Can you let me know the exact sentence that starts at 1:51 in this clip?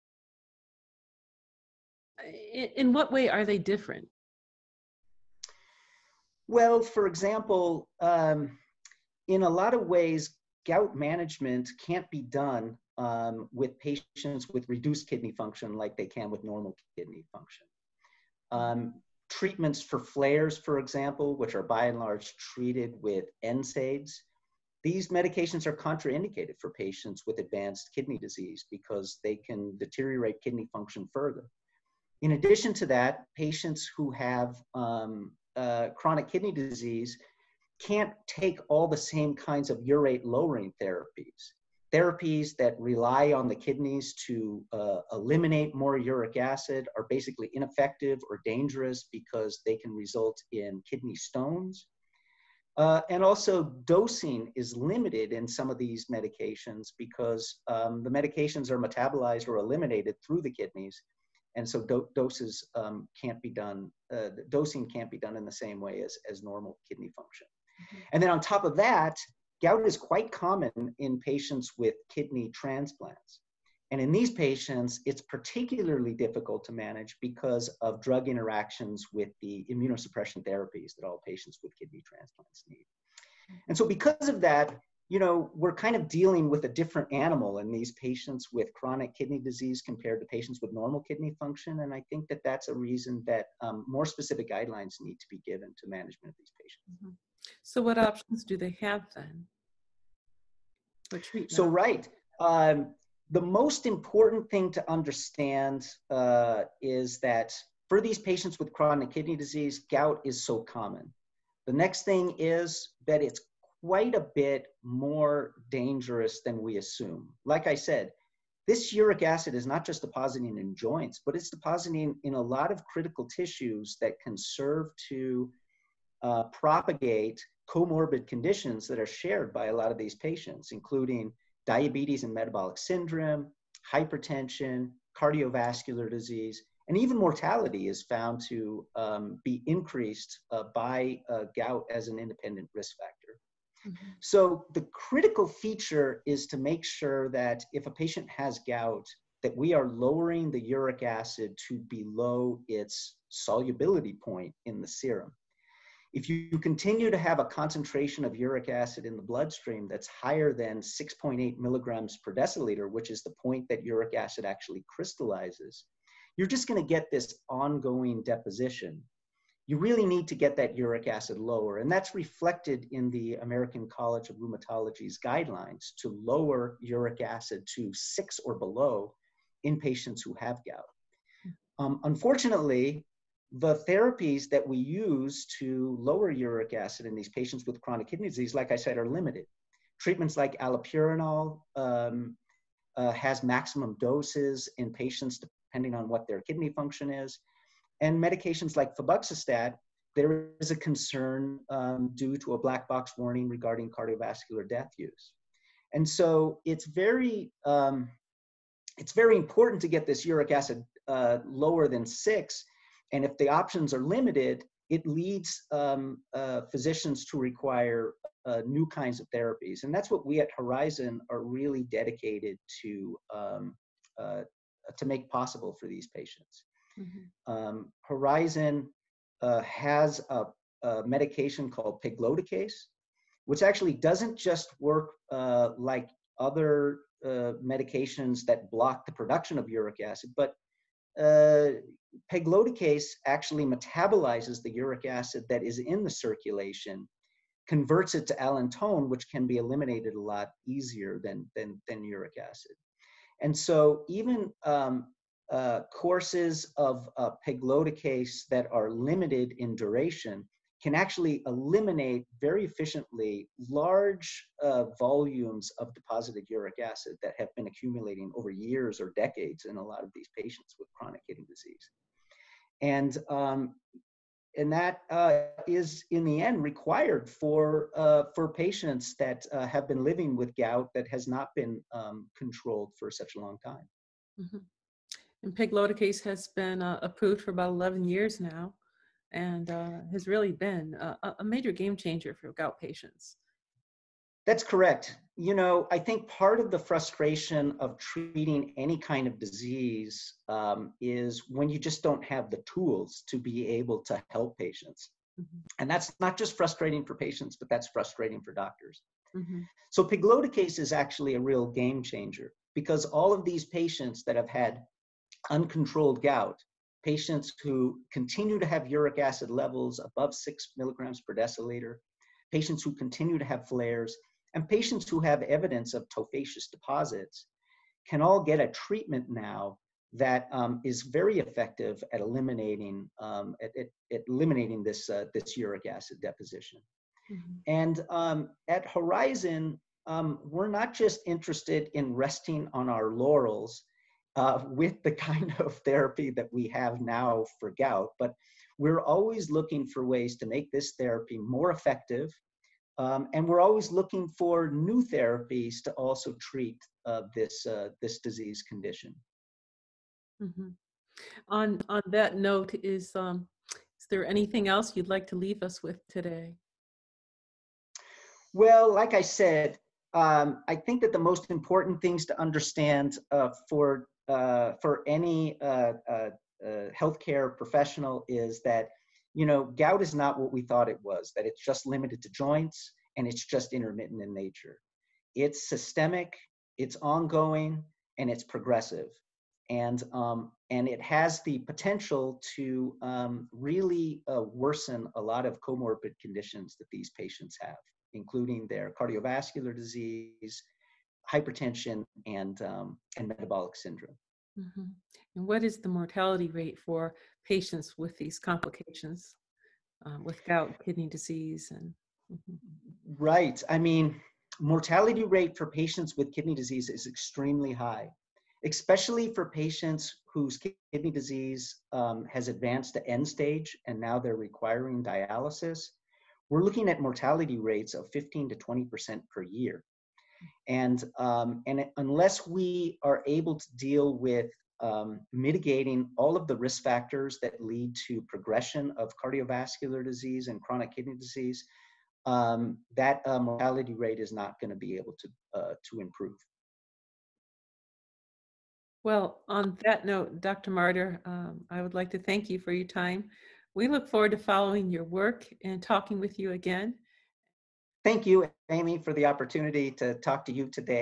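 The next thing is that it's quite a bit more dangerous than we assume.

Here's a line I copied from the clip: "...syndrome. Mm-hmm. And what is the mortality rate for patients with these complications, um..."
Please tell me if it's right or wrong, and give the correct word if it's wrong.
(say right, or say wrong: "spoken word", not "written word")
right.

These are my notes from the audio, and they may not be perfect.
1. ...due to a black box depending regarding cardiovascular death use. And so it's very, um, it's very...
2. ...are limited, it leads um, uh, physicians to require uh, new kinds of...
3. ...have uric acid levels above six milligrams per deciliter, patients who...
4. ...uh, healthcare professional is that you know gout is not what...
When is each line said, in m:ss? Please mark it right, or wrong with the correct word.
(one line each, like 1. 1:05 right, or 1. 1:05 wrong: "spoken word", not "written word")
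1. 3:22 wrong: "warning", not "depending"
2. 3:33 right
3. 5:18 right
4. 6:16 right.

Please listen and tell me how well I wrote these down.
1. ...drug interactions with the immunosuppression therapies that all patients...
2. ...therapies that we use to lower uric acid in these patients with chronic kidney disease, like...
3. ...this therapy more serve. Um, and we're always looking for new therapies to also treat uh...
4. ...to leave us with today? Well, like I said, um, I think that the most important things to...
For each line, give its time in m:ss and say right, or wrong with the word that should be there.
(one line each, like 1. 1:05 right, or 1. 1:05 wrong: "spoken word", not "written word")
1. 1:18 right
2. 3:03 right
3. 5:50 wrong: "effective", not "serve"
4. 6:05 right.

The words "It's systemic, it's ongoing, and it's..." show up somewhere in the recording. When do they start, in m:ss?
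6:25.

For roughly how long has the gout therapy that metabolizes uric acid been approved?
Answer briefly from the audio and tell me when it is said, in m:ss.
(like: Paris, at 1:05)
11 years, at 4:47.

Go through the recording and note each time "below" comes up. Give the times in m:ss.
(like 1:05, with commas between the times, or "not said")
2:31, 2:58.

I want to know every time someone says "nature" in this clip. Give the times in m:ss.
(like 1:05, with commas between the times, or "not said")
6:24.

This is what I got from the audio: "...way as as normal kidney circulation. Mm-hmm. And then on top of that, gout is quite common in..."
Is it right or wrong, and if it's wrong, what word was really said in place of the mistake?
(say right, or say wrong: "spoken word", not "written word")
wrong: "function", not "circulation".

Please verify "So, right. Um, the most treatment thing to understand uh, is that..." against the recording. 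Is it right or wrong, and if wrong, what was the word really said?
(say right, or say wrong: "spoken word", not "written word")
wrong: "important", not "treatment".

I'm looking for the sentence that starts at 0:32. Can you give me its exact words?
In addition to that, patients who have um, uh, chronic kidney disease can't take all the same kinds of urate lowering therapies.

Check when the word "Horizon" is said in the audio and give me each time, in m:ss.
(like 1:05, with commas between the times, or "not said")
3:40, 3:48, 5:38.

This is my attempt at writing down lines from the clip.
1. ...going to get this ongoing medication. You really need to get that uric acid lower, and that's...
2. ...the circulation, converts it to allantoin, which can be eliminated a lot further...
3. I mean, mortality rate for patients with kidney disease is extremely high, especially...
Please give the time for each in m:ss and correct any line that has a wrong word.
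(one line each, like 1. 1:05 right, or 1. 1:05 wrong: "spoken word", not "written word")
1. 2:46 wrong: "deposition", not "medication"
2. 4:06 wrong: "easier", not "further"
3. 6:53 right.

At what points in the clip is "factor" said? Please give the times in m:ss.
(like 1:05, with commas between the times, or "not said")
2:22, 7:16.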